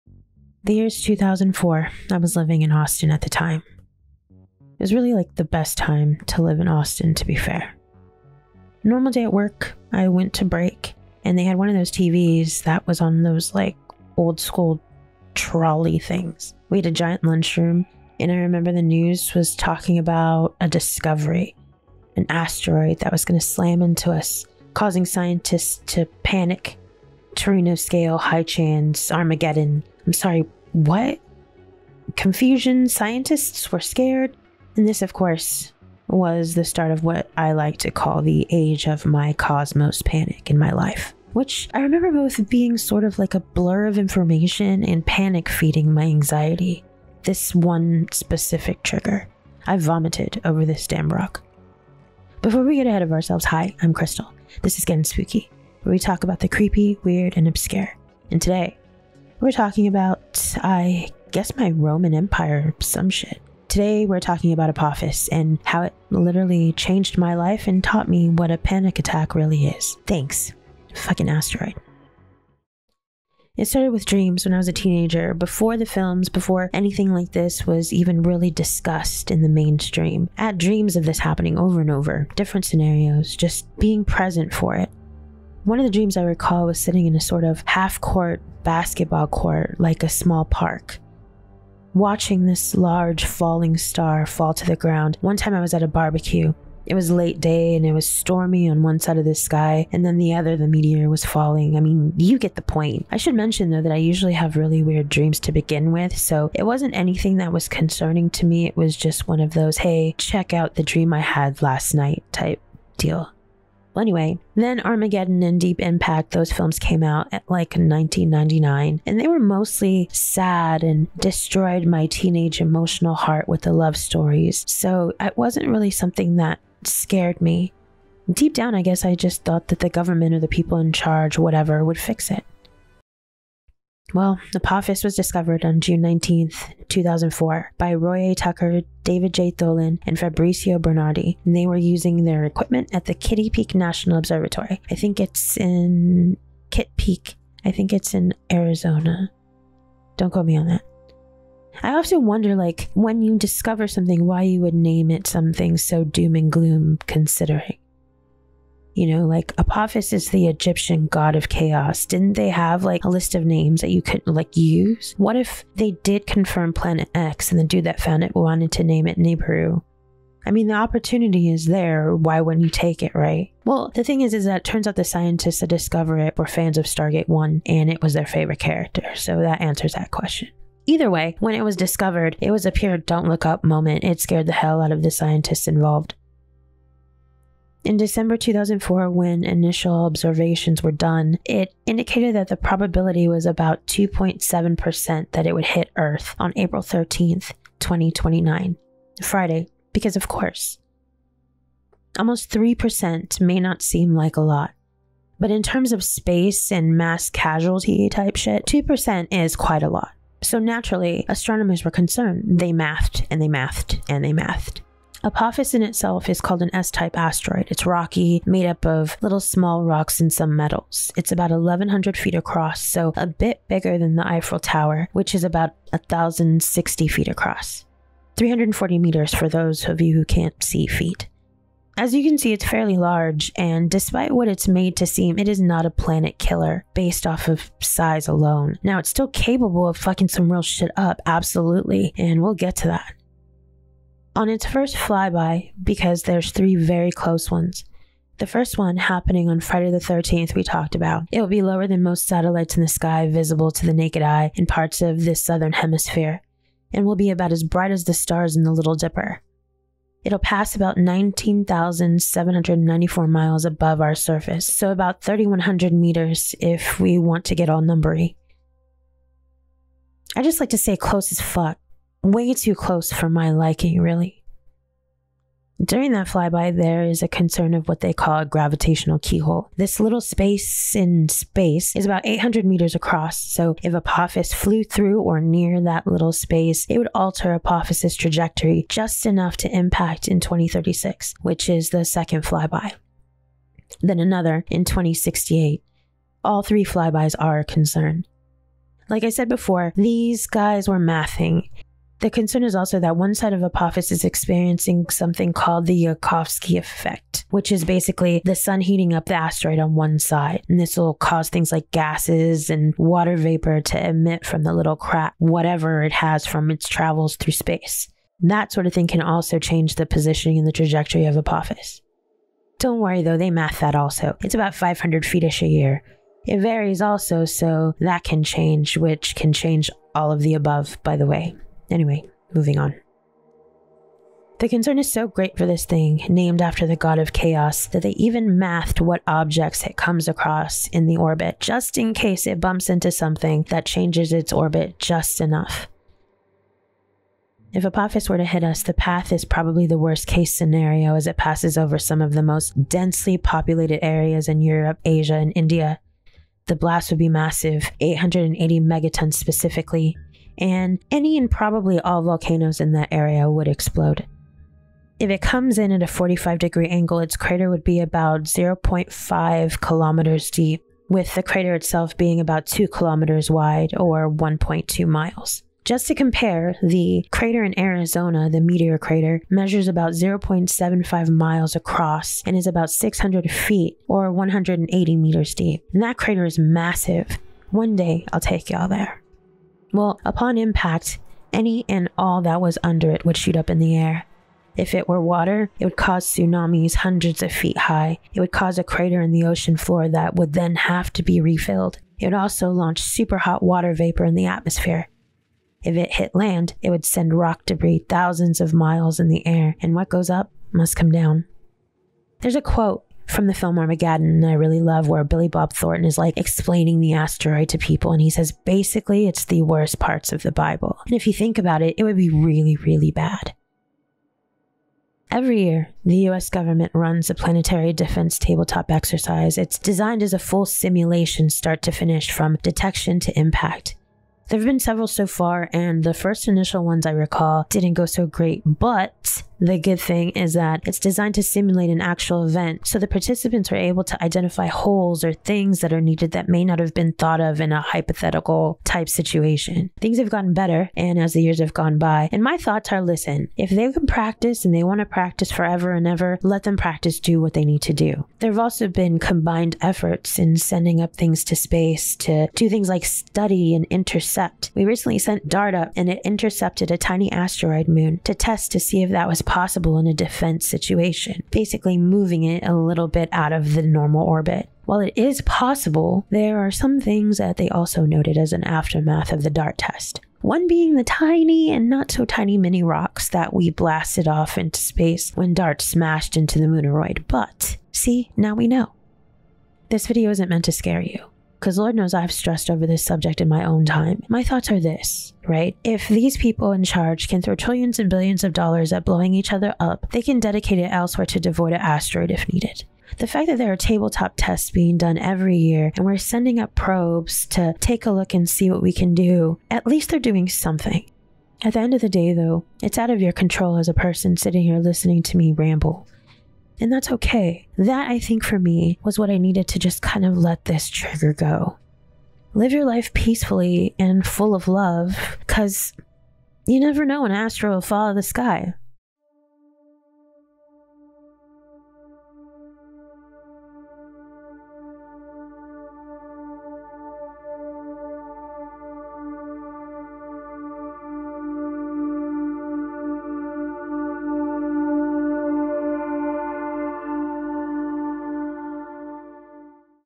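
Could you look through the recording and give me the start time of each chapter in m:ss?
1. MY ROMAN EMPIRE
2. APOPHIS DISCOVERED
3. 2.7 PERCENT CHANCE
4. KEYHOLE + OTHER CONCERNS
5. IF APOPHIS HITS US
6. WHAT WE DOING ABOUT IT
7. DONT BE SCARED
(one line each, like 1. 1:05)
1. 1:12
2. 2:13
3. 3:06
4. 4:35
5. 5:46
6. 7:04
7. 8:09.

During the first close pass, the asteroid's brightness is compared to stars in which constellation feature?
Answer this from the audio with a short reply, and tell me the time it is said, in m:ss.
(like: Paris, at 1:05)
Little Dipper, at 4:18.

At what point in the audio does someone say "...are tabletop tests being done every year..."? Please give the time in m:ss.
8:23.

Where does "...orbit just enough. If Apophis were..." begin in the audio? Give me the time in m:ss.
5:44.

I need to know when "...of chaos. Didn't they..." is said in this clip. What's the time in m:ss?
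2:41.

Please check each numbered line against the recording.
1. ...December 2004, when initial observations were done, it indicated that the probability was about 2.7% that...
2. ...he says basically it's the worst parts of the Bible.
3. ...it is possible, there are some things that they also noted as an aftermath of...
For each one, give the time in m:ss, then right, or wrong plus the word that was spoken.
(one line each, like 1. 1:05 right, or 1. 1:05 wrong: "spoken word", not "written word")
1. 3:07 right
2. 6:58 right
3. 7:55 right.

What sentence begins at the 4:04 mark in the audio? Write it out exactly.
On its first flyby, because there's three very close ones, the first one happening on Friday the 13th, we talked about.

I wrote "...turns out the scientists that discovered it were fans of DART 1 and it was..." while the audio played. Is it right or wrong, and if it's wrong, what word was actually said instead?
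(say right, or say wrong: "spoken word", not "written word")
wrong: "Stargate", not "DART".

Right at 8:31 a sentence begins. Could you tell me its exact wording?
At the end of the day, though, it's out of your control as a person sitting here listening to me ramble.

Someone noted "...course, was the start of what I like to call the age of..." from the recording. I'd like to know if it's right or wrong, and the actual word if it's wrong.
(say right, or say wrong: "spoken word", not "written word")
right.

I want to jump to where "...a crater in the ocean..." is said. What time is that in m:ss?
6:38.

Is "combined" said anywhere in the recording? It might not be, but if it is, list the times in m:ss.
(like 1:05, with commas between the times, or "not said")
7:39.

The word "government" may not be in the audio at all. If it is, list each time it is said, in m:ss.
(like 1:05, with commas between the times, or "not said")
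2:09, 7:06.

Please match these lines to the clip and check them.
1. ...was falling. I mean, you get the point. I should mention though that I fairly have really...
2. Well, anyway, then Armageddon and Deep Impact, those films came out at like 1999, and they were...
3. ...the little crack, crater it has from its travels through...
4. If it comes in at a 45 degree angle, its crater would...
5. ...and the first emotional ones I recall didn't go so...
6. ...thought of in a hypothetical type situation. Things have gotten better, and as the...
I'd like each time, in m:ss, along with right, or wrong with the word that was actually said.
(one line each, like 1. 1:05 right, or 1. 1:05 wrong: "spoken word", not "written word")
1. 1:41 wrong: "usually", not "fairly"
2. 1:53 right
3. 5:14 wrong: "whatever", not "crater"
4. 6:05 right
5. 7:15 wrong: "initial", not "emotional"
6. 7:27 right.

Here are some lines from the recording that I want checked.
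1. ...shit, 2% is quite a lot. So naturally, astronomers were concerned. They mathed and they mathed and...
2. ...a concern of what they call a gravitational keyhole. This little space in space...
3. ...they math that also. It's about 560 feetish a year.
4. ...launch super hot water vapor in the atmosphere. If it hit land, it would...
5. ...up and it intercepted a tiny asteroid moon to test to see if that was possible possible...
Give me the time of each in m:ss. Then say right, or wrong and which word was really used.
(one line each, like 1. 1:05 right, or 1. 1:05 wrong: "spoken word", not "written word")
1. 3:28 right
2. 4:37 right
3. 5:23 wrong: "500", not "560"
4. 6:42 right
5. 7:45 right.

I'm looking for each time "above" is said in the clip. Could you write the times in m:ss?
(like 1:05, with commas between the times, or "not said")
4:23, 5:30.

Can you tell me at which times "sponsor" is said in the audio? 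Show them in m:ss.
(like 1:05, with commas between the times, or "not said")
not said.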